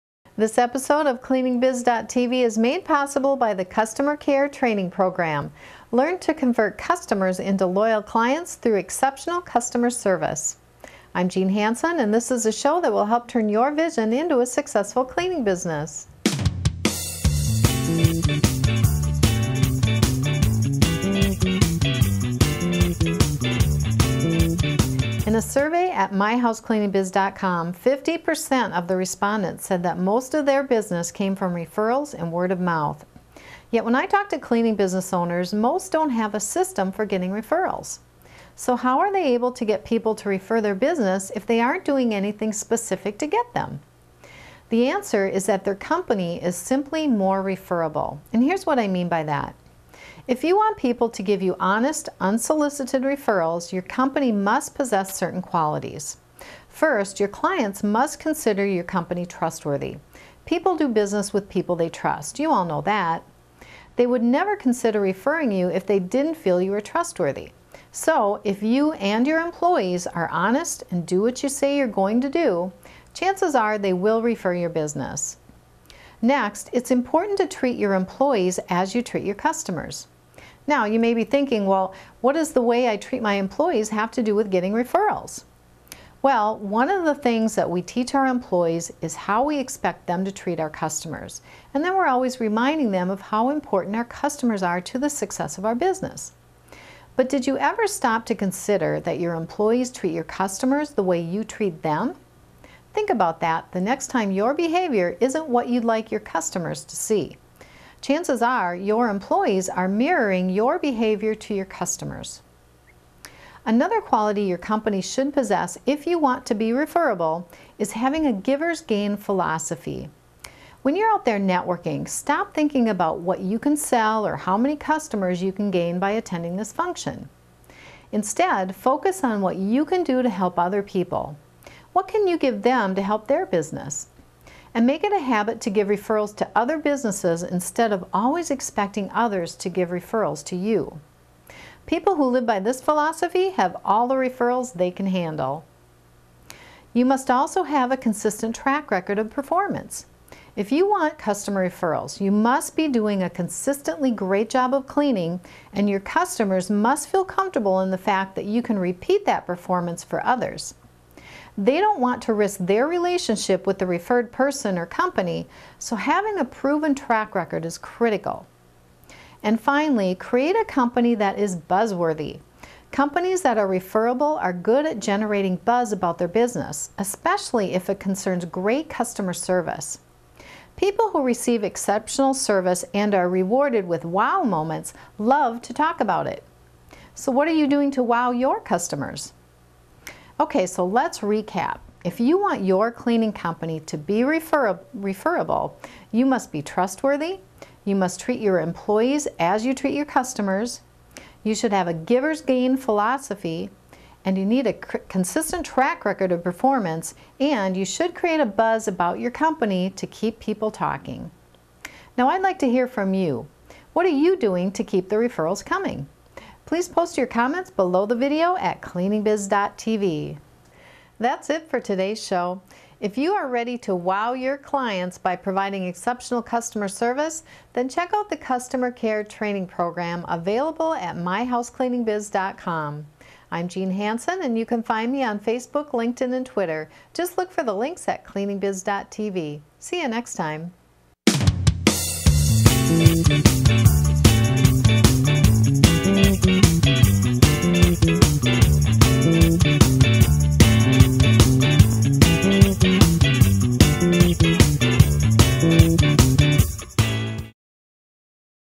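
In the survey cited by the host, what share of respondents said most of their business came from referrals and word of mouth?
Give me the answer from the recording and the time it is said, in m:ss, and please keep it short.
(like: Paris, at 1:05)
50%, at 0:27.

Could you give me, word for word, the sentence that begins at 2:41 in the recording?
They don't want to risk their relationship with the referred person or company, so having a proven track record is critical.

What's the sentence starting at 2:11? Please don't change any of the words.
What can you give them to help their business?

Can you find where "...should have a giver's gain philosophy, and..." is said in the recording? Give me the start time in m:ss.
3:21.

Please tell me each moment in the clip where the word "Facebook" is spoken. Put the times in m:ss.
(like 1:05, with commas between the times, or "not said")
3:55.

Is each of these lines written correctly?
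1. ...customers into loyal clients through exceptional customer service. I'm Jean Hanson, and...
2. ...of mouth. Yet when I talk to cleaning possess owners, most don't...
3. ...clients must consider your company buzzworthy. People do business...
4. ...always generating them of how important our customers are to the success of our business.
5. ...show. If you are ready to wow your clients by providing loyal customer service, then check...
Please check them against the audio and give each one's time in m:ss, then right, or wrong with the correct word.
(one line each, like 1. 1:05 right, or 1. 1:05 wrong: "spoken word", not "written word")
1. 0:06 right
2. 0:32 wrong: "business", not "possess"
3. 0:57 wrong: "trustworthy", not "buzzworthy"
4. 1:32 wrong: "reminding", not "generating"
5. 3:42 wrong: "exceptional", not "loyal".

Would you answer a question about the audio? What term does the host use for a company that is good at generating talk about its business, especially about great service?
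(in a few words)
buzzworthy.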